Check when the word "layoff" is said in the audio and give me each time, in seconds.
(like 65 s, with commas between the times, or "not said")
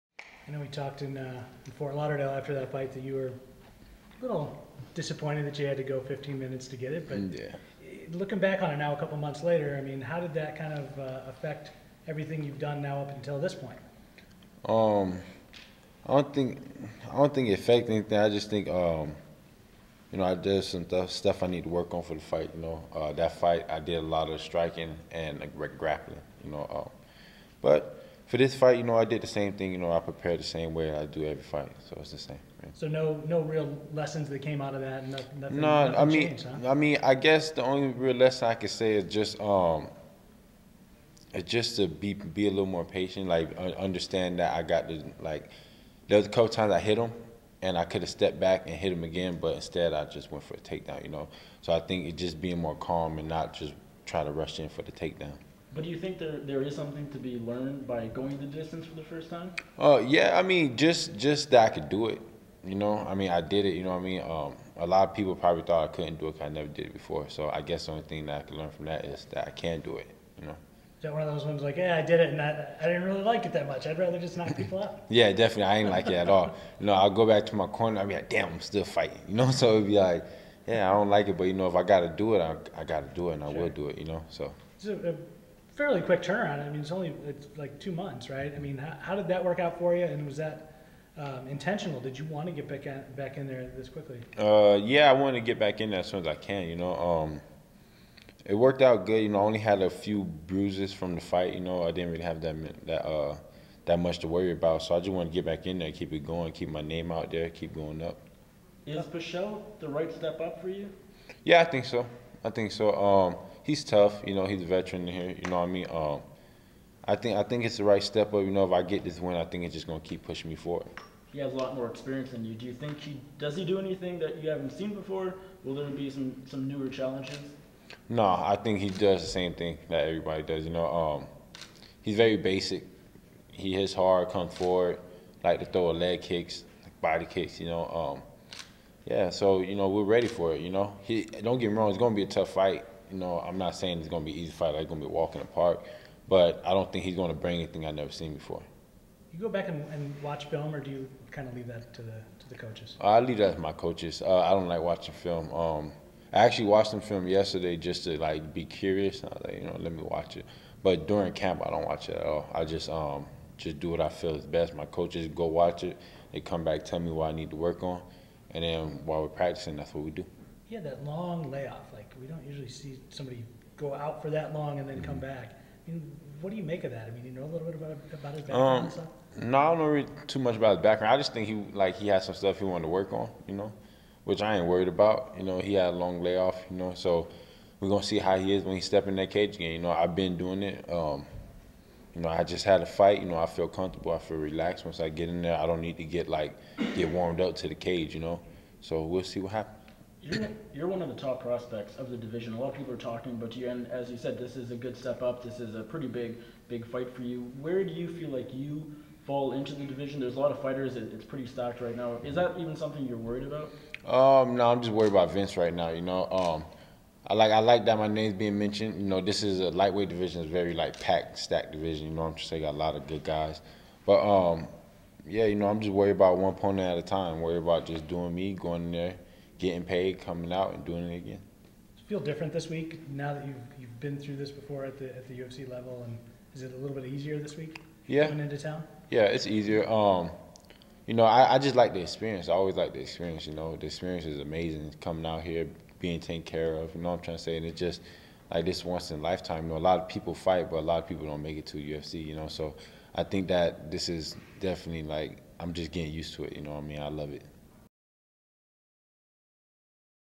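171 s, 186 s.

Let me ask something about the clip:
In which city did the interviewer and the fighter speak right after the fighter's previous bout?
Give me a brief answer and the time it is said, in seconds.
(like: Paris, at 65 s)
Fort Lauderdale, at 1 s.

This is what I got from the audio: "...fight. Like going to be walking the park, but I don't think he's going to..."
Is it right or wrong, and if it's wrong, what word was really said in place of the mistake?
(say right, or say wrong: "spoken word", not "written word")
right.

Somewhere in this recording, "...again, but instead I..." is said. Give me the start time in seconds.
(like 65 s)
49 s.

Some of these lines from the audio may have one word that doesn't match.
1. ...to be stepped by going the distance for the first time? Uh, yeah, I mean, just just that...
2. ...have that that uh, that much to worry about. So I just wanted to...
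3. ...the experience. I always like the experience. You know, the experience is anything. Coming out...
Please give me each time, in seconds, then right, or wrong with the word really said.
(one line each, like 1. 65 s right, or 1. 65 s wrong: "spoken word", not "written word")
1. 57 s wrong: "learned", not "stepped"
2. 102 s right
3. 241 s wrong: "amazing", not "anything".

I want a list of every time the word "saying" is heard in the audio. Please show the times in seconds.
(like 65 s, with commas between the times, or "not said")
143 s, 222 s.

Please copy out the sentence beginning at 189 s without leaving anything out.
You know, I've been doing it.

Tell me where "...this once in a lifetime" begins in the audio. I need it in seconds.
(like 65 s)
248 s.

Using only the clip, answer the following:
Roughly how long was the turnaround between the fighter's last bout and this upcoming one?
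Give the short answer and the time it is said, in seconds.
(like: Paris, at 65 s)
2 months, at 87 s.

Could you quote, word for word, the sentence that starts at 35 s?
Nothing, nothing, no, nothing I mean, huh?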